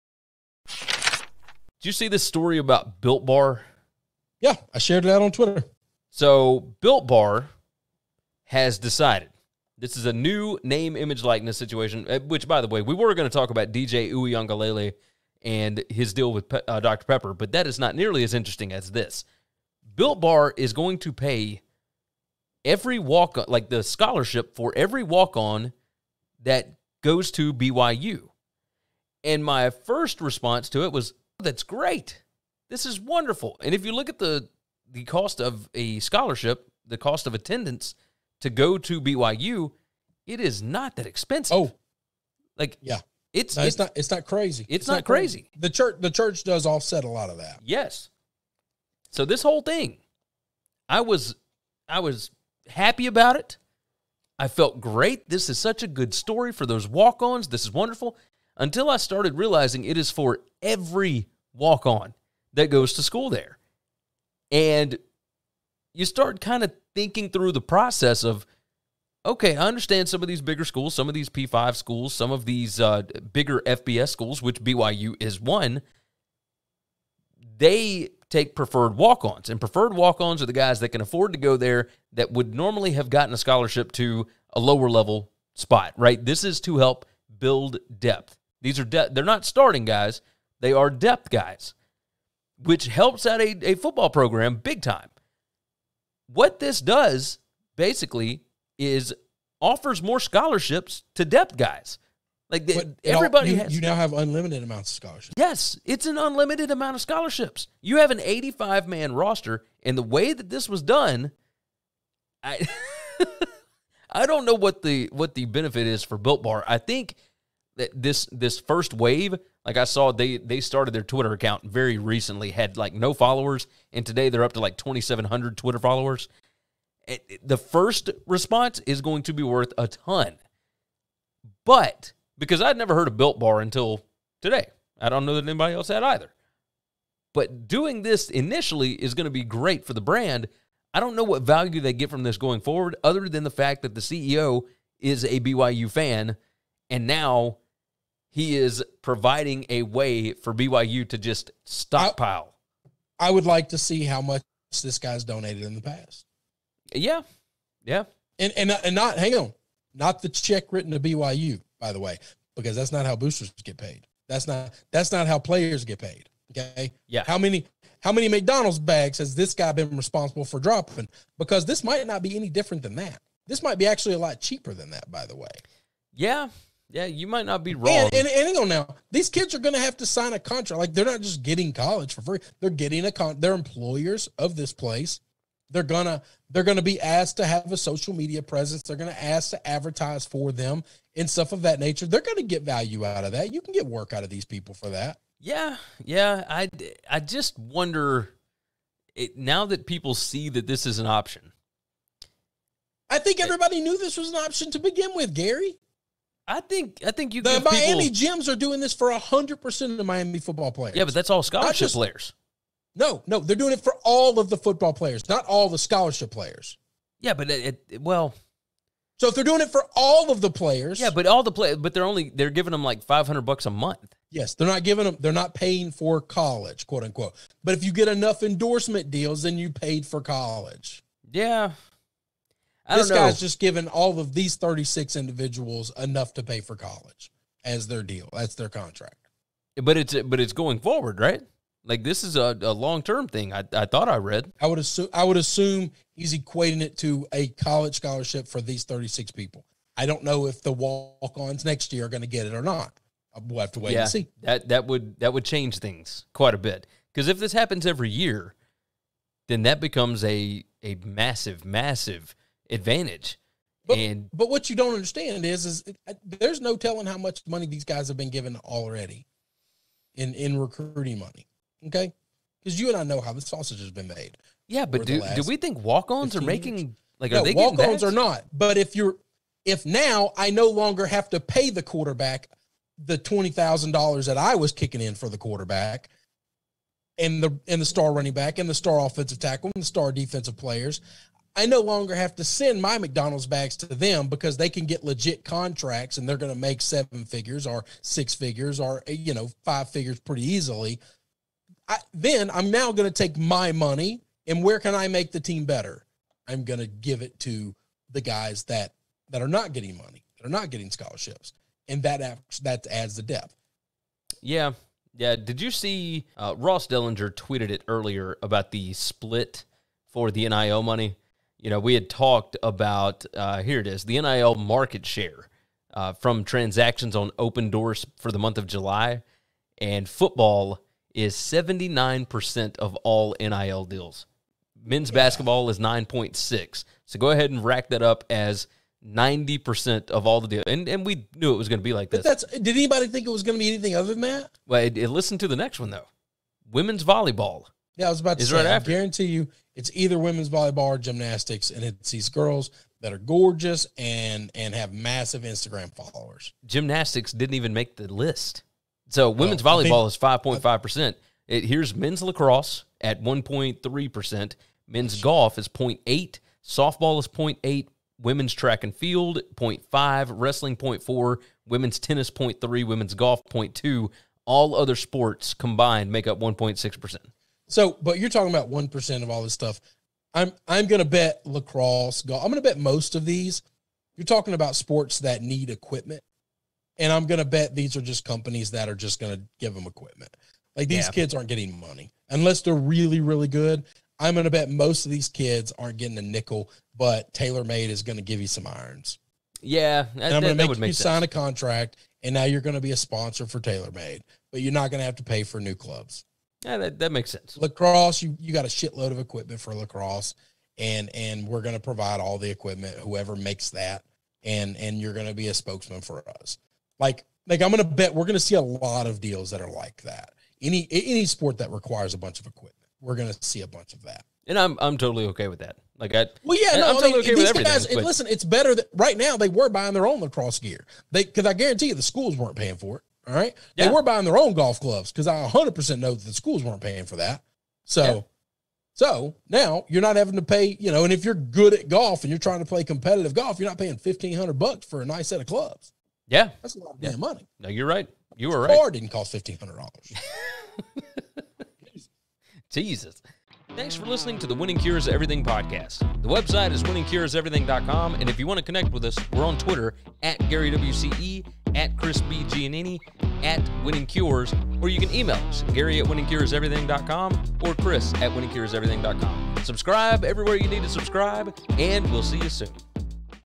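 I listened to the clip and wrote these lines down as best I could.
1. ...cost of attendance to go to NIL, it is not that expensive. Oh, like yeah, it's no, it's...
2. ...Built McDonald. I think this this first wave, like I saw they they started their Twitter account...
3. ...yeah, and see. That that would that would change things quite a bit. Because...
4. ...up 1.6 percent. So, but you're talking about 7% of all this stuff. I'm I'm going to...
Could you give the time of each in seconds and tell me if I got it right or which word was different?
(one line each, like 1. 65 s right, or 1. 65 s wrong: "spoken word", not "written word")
1. 36 s wrong: "BYU", not "NIL"
2. 116 s wrong: "Bar", not "McDonald"
3. 253 s right
4. 376 s wrong: "1", not "7".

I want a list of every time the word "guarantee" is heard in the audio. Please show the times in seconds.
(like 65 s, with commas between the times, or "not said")
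348 s, 431 s.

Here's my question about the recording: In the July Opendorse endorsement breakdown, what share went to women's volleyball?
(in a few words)
5.5%.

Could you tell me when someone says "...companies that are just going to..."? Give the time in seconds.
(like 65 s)
388 s.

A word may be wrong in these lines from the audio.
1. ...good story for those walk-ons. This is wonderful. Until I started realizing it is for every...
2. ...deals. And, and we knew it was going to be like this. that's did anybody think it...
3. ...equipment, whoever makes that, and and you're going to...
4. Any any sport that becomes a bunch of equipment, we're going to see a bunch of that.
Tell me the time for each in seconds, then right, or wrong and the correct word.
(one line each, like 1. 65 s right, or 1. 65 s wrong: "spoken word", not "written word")
1. 55 s right
2. 340 s right
3. 412 s right
4. 420 s wrong: "requires", not "becomes".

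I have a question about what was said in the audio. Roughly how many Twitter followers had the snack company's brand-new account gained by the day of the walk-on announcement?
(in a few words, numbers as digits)
2700.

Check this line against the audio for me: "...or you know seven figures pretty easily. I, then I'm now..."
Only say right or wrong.
wrong.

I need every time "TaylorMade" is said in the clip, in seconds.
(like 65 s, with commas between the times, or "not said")
397 s, 403 s.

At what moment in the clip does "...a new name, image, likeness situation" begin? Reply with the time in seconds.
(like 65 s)
10 s.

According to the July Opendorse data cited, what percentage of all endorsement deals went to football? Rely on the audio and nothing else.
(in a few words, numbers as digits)
79%.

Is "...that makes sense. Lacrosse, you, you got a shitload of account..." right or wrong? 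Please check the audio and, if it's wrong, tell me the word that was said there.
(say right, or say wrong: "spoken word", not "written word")
wrong: "equipment", not "account".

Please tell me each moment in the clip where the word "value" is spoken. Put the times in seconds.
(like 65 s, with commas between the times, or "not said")
141 s, 192 s.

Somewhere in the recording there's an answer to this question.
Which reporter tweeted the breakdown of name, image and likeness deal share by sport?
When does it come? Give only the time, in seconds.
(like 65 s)
316 s.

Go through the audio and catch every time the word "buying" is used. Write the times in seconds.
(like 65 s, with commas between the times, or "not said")
429 s, 434 s.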